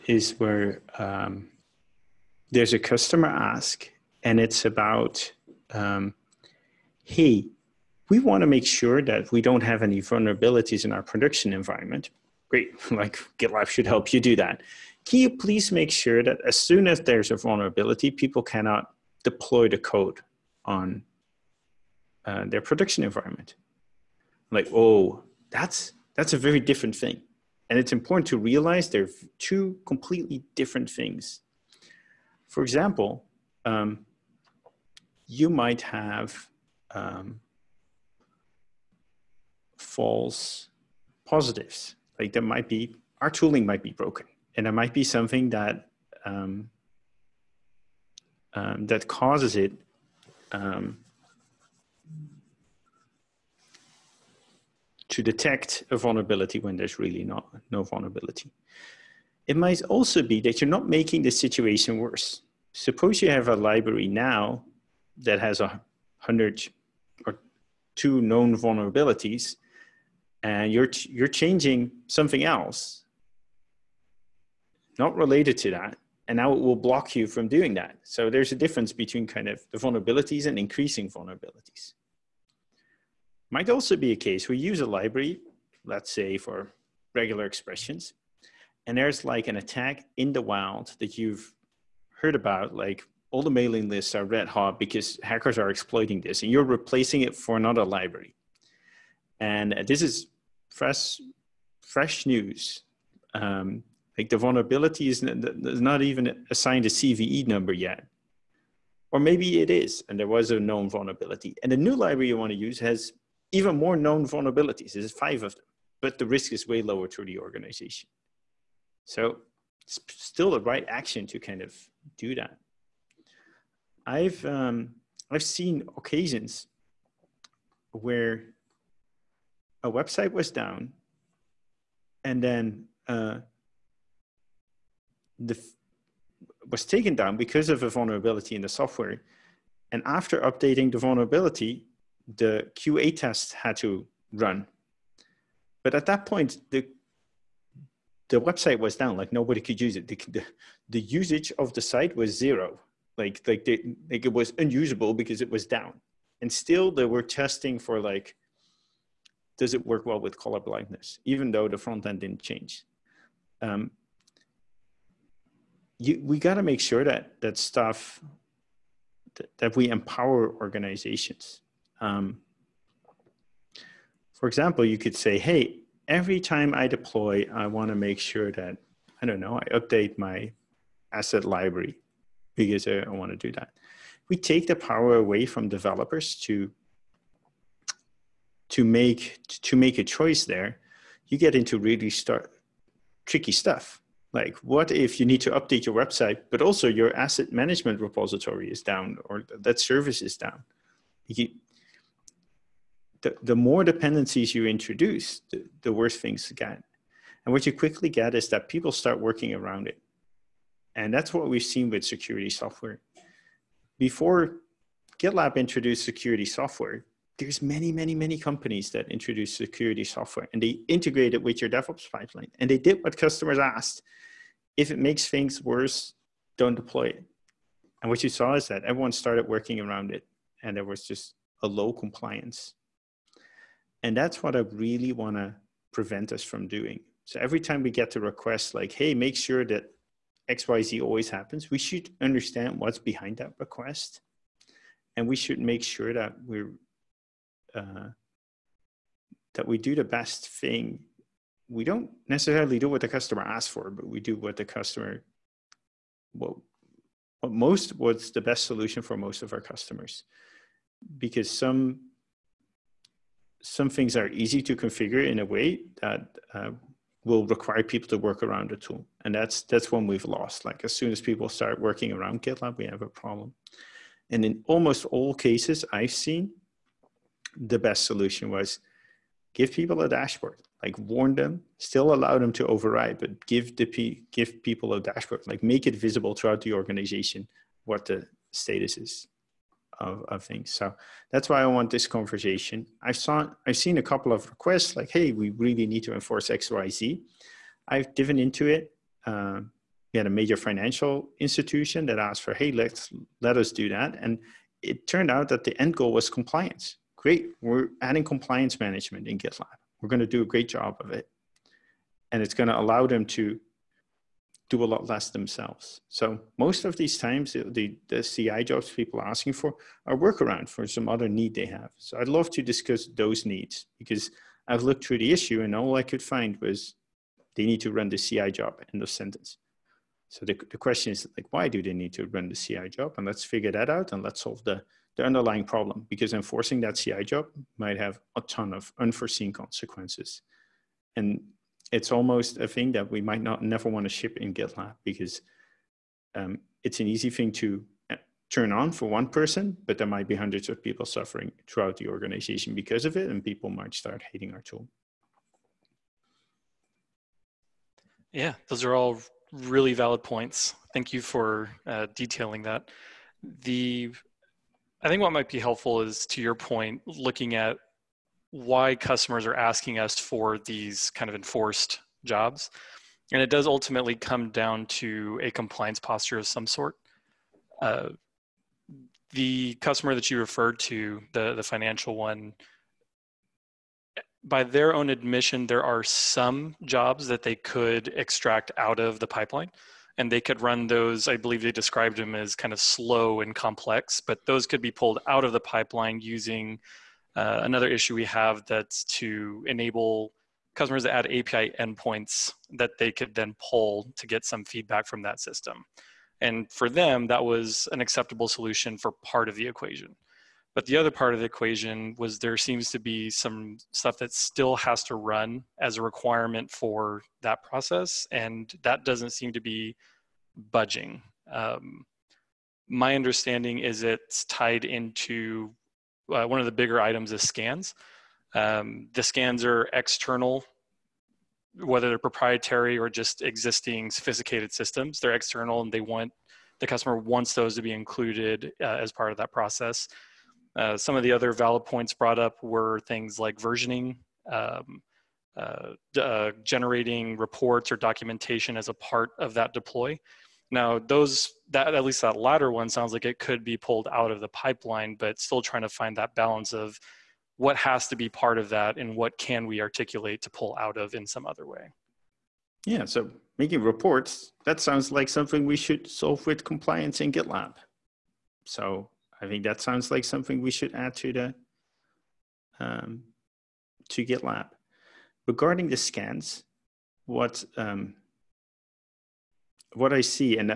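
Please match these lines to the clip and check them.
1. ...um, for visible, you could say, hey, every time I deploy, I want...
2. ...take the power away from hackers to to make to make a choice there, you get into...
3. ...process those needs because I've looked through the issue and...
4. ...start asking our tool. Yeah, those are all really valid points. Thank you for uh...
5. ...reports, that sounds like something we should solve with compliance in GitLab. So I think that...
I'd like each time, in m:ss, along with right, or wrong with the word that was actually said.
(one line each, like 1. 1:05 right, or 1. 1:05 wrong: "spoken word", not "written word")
1. 2:52 wrong: "example", not "visible"
2. 3:04 wrong: "developers", not "hackers"
3. 5:22 wrong: "discuss", not "process"
4. 5:53 wrong: "hating", not "asking"
5. 7:43 right.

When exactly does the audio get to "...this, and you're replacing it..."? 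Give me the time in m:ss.
1:36.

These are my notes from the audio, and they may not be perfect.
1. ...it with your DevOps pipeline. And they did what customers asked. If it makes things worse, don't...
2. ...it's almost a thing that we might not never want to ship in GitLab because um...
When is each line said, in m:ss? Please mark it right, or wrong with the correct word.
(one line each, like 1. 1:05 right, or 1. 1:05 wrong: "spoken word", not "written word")
1. 3:41 right
2. 5:41 right.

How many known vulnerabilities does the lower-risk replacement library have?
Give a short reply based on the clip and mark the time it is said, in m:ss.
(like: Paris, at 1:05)
5, at 1:55.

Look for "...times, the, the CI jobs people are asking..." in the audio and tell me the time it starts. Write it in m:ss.
5:17.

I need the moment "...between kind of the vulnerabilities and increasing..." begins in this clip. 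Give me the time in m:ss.
1:18.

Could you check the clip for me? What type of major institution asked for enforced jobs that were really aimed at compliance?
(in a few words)
financial institution.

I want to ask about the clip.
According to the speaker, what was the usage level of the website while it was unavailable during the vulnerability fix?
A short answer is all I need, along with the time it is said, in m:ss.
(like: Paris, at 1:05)
0, at 2:32.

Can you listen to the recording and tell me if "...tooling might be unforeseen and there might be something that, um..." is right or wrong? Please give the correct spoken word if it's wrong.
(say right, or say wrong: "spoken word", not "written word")
wrong: "broken", not "unforeseen".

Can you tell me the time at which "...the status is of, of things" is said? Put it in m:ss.
4:48.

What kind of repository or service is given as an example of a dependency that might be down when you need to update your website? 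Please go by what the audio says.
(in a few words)
asset management.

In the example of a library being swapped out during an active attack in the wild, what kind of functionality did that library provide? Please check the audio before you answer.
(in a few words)
regular expressions.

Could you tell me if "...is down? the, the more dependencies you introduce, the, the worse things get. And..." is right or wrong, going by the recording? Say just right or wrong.
right.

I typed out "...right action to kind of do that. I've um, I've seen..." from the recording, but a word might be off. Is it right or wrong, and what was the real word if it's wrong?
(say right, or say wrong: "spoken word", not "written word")
right.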